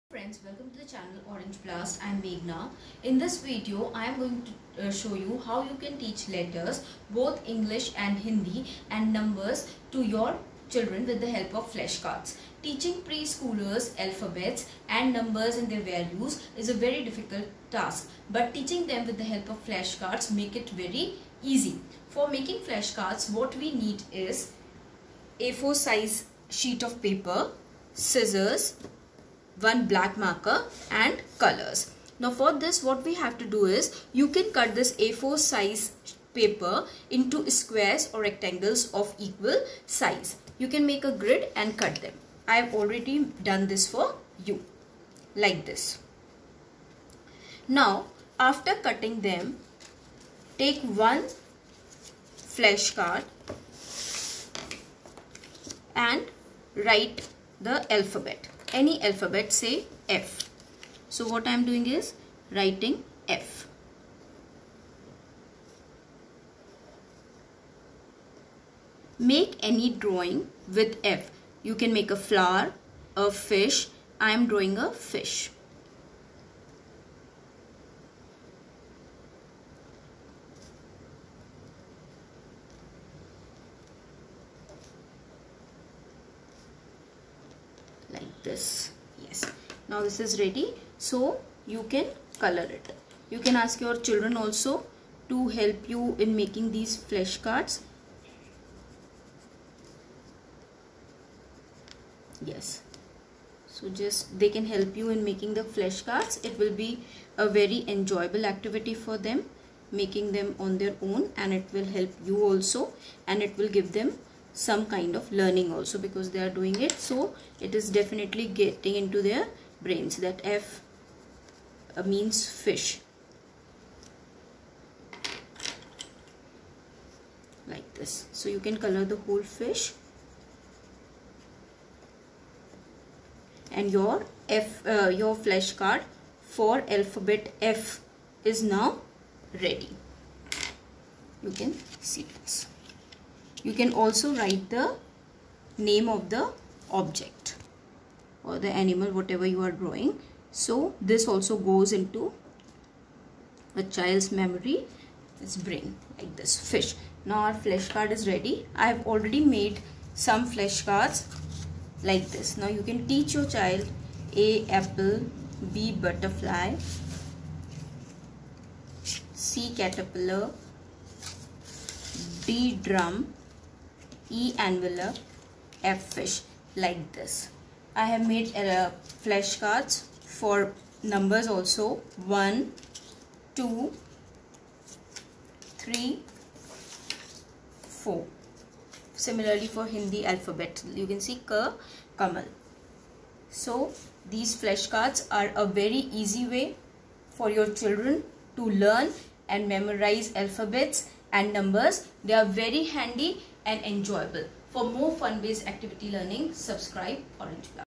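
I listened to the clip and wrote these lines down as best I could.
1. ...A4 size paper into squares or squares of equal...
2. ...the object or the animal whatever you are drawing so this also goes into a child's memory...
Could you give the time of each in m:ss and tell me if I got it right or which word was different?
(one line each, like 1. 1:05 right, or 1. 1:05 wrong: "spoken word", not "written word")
1. 0:34 wrong: "rectangles", not "squares"
2. 2:26 right.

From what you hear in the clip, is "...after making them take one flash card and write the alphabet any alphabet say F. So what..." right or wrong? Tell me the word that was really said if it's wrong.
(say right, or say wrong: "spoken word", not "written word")
wrong: "cutting", not "making".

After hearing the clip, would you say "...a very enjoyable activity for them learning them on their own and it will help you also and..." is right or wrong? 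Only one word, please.
wrong.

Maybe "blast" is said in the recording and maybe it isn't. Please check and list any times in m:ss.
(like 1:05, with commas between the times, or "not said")
0:01, 3:27.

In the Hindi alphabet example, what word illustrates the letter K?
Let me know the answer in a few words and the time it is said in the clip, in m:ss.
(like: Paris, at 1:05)
Kamal, at 3:12.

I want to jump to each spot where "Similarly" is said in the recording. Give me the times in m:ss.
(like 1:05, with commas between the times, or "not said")
3:09.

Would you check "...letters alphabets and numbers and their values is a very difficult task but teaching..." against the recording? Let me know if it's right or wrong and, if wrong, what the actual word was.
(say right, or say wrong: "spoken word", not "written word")
wrong: "preschoolers", not "letters".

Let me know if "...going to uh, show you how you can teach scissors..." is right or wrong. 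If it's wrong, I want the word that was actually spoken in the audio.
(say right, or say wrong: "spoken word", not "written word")
wrong: "letters", not "scissors".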